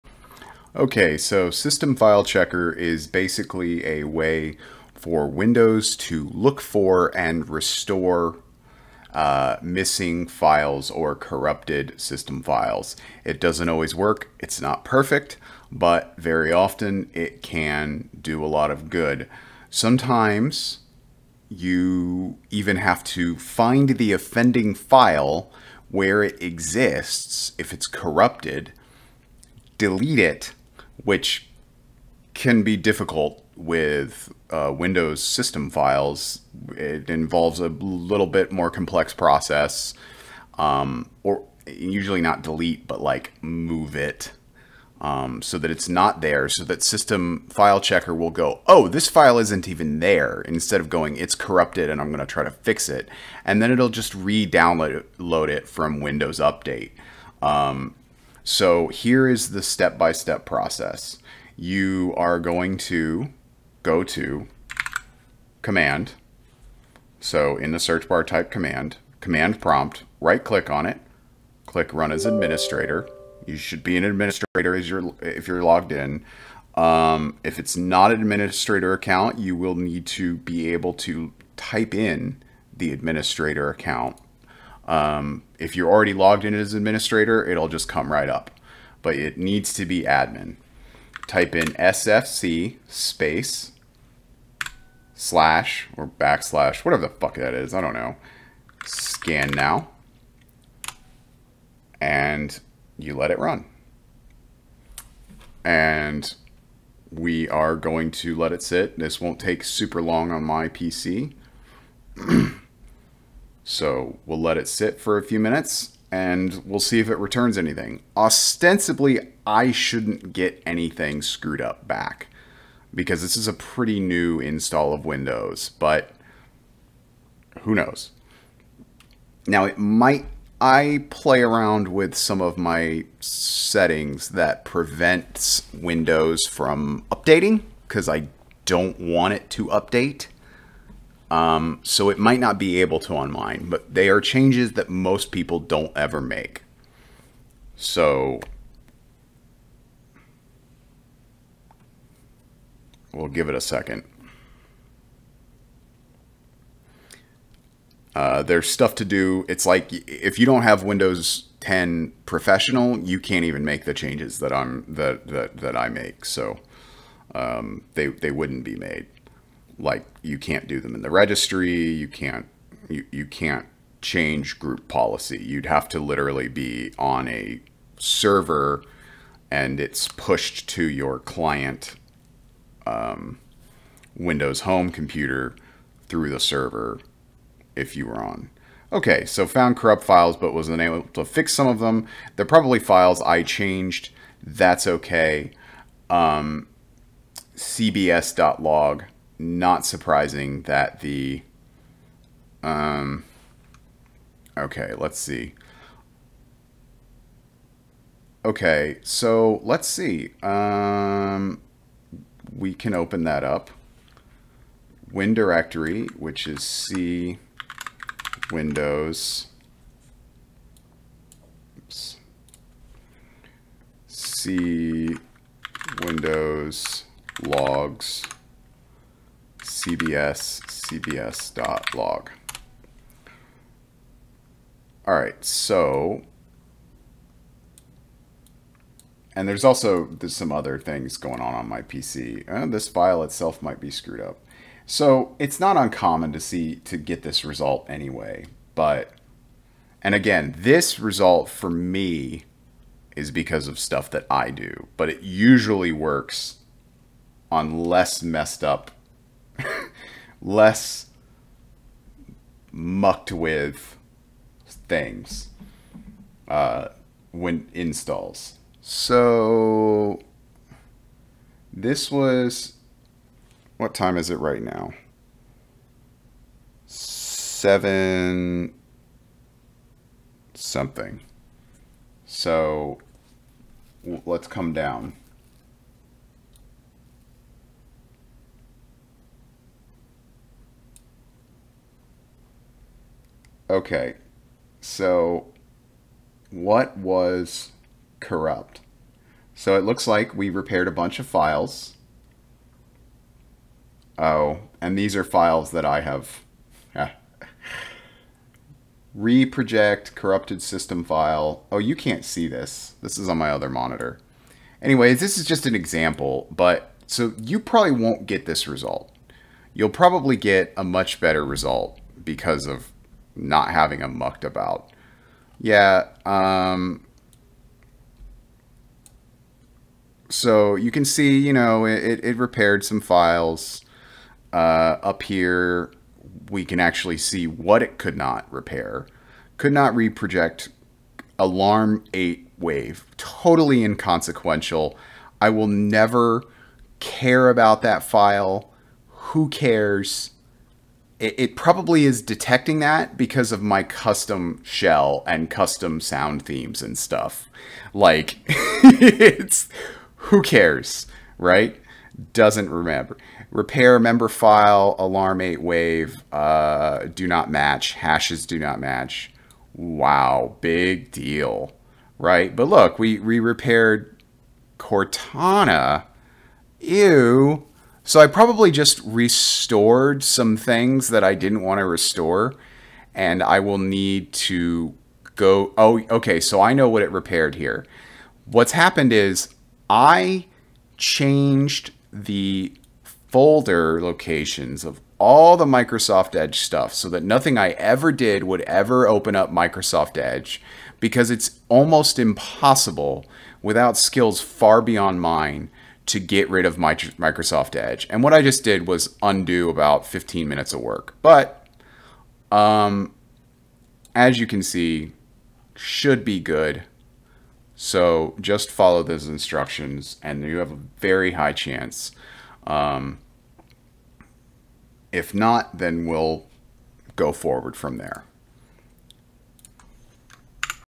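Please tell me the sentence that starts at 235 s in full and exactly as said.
All right, so, and there's also there's some other things going on on my PC.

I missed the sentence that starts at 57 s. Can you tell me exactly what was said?
Um, so here is the step-by-step process.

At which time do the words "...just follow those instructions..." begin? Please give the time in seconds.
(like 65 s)
418 s.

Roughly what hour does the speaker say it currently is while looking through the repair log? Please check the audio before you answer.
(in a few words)
Seven something.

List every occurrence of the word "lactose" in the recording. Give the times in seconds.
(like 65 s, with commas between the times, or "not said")
not said.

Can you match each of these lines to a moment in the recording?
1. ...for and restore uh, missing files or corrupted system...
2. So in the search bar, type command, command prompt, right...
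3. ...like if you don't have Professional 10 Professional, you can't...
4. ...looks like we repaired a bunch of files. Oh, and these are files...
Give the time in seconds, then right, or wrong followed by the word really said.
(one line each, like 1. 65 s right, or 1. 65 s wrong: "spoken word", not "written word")
1. 6 s right
2. 67 s right
3. 159 s wrong: "Windows", not "Professional"
4. 299 s right.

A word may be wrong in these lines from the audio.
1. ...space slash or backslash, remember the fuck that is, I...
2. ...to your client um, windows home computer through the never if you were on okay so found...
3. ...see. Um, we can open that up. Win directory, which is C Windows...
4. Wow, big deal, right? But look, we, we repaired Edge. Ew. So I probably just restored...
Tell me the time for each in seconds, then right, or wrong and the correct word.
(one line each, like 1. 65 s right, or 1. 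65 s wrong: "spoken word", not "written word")
1. 92 s wrong: "whatever", not "remember"
2. 180 s wrong: "server", not "never"
3. 209 s right
4. 369 s wrong: "Cortana", not "Edge".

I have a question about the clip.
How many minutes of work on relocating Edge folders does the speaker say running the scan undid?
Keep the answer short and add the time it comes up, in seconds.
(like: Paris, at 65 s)
15, at 410 s.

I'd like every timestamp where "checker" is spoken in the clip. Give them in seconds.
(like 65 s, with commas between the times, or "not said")
2 s, 47 s.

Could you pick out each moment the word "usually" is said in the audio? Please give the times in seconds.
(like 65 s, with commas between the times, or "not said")
41 s, 255 s.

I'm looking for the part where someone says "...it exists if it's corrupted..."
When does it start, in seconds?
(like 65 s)
26 s.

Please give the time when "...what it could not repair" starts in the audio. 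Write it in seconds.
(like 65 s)
337 s.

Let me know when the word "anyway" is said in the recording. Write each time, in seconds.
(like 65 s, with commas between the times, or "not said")
247 s, 314 s.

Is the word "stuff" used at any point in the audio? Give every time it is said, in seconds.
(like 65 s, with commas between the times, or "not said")
158 s, 253 s, 356 s, 396 s.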